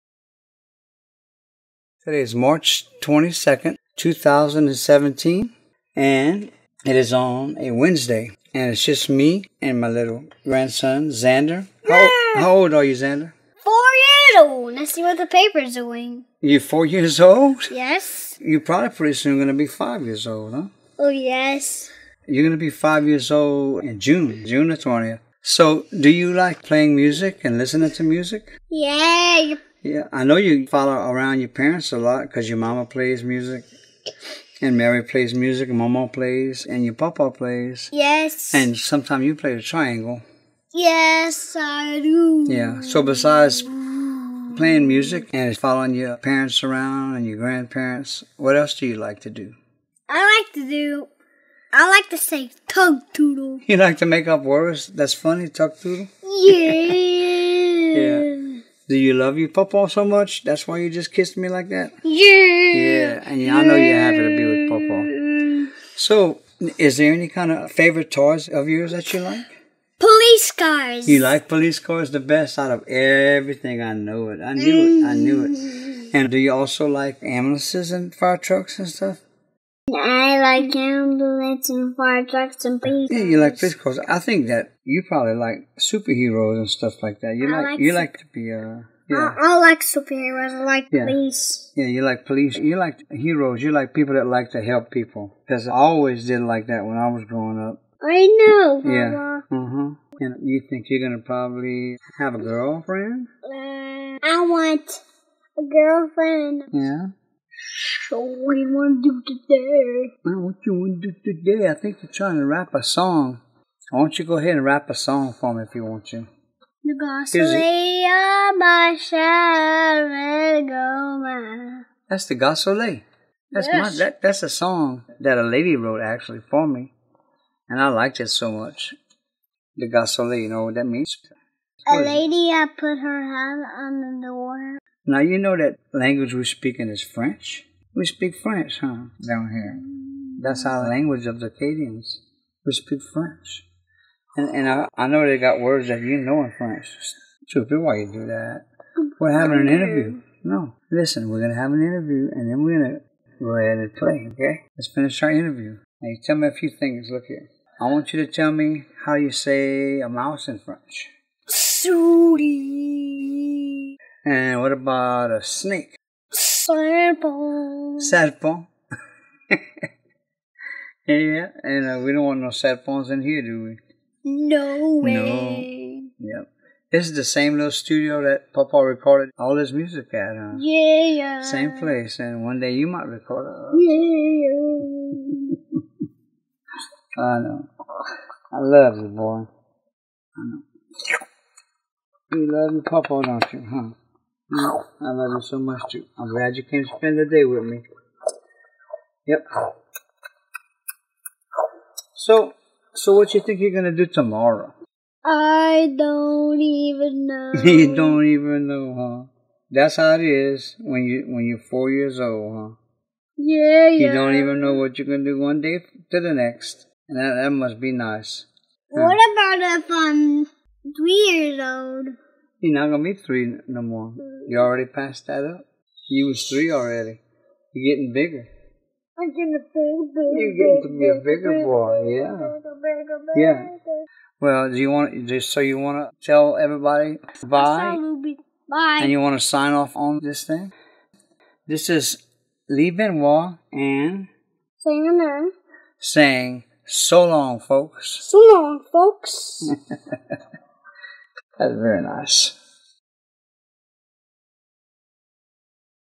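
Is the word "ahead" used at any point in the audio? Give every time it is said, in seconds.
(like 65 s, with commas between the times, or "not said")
114 s, 153 s.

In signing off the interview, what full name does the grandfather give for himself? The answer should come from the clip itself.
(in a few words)
Lee Benoit.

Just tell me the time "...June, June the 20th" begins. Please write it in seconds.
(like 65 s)
23 s.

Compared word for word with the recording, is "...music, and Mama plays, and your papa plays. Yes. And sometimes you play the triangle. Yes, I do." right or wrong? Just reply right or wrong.
right.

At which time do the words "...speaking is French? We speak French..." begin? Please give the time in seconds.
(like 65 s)
136 s.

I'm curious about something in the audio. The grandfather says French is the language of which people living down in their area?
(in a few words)
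The Acadians.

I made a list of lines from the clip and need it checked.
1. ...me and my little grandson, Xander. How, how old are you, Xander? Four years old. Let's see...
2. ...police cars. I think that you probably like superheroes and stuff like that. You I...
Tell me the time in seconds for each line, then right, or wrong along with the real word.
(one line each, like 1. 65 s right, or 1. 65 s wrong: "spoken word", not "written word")
1. 9 s right
2. 83 s right.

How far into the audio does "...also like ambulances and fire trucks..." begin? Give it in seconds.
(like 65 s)
76 s.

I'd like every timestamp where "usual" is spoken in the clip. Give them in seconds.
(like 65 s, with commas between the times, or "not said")
not said.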